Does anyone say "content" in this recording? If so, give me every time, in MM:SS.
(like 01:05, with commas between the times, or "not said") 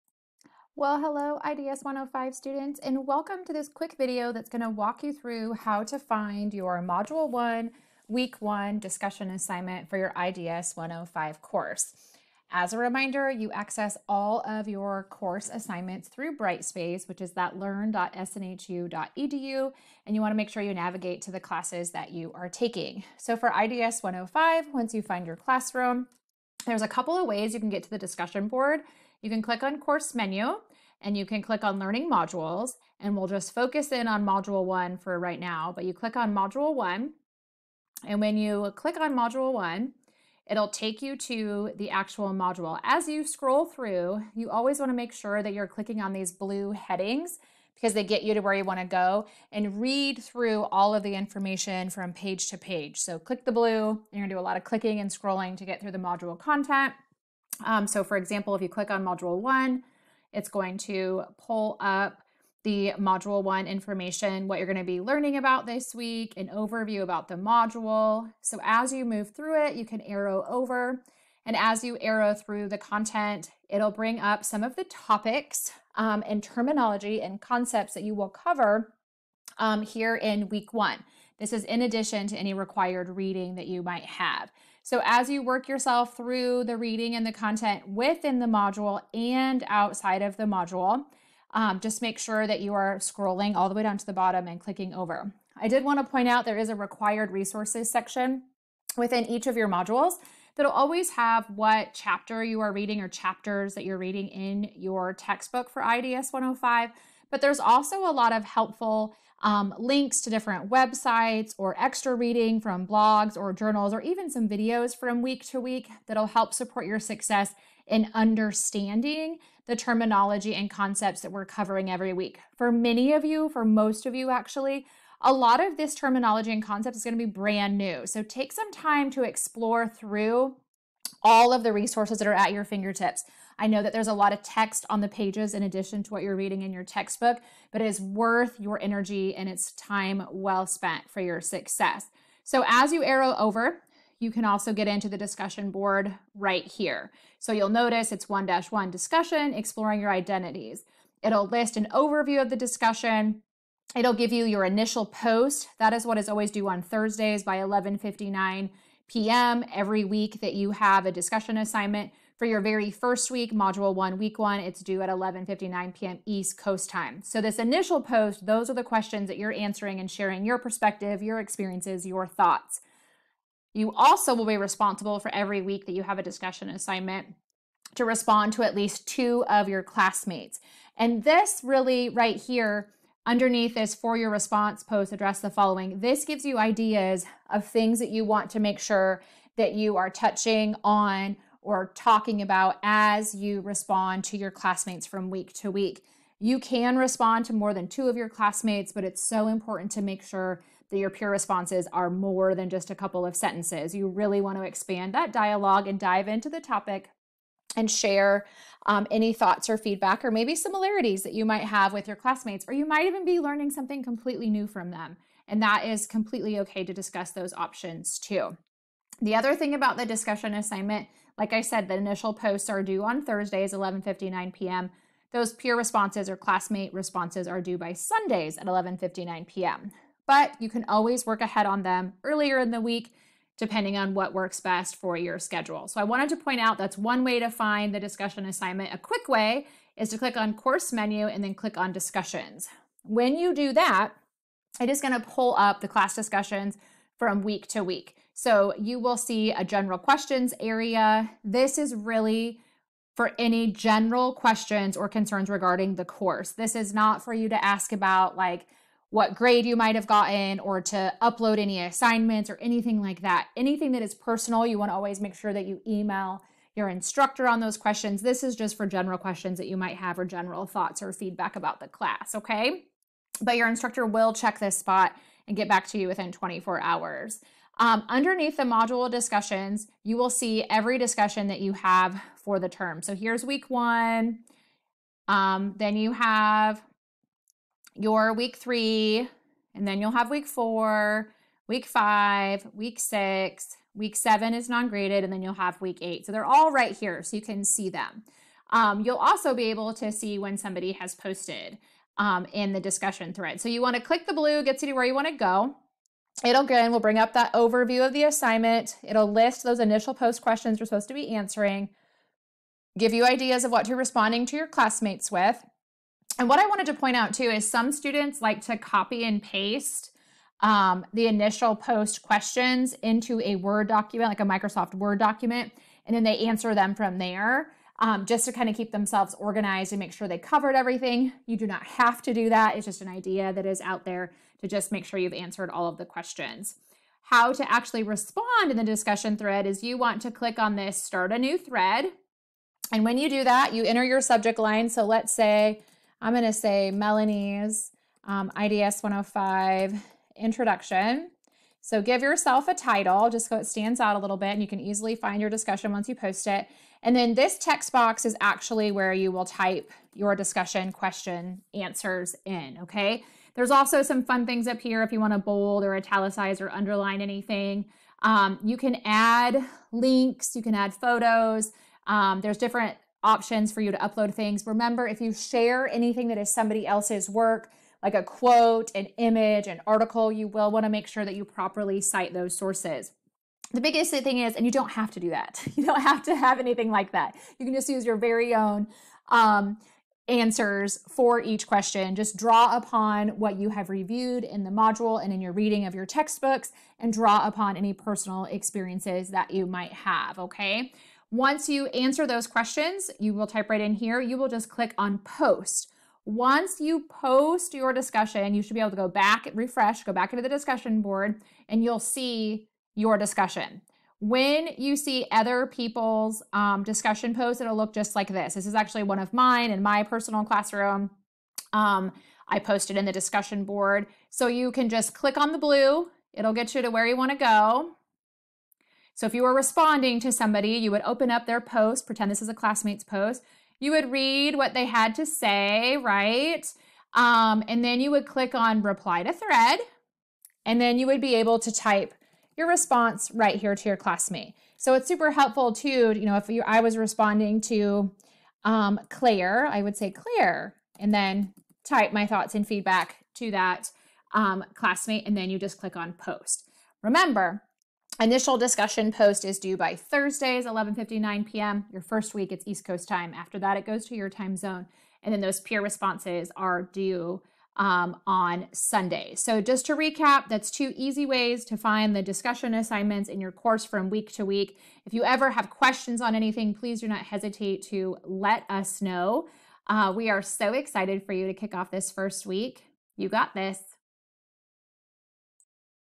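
00:56, 01:12, 01:27.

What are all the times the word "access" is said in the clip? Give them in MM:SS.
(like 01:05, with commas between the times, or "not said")
00:13.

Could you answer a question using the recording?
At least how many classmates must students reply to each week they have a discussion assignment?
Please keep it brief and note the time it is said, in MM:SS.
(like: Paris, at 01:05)
2, at 02:58.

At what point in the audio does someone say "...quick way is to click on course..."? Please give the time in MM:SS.
03:58.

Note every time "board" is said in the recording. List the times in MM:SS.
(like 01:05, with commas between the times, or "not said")
00:28, 02:25, 06:51, 07:03.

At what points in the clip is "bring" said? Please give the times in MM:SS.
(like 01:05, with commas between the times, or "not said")
01:13, 05:06.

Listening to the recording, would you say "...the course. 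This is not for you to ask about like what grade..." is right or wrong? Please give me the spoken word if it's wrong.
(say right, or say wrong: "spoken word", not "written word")
right.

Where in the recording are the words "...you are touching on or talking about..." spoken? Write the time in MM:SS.
03:09.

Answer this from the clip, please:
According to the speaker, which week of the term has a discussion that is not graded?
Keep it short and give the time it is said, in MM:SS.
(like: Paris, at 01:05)
Week 7, at 04:53.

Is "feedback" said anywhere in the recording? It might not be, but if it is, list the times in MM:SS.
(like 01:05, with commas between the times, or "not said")
03:29, 04:31, 07:32.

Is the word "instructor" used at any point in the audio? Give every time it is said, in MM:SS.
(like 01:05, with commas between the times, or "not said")
04:26, 04:33.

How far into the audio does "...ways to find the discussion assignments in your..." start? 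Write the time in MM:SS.
07:51.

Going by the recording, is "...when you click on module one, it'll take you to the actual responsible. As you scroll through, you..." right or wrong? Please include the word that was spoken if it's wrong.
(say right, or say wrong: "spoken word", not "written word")
wrong: "module", not "responsible".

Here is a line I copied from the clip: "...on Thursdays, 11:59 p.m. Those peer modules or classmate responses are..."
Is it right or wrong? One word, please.
wrong.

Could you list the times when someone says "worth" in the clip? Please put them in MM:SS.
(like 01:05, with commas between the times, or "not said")
02:18.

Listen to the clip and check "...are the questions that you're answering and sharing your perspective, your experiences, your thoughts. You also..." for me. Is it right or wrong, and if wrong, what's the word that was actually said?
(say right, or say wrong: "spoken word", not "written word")
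right.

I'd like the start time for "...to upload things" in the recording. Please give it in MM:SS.
06:13.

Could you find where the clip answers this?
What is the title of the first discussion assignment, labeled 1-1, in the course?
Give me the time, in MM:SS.
02:29.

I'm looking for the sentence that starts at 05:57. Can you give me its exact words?
And then this text box is actually where you will type your discussion question answers in, okay?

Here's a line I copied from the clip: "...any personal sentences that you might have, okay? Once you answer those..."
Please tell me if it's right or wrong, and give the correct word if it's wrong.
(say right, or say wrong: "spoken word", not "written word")
wrong: "experiences", not "sentences".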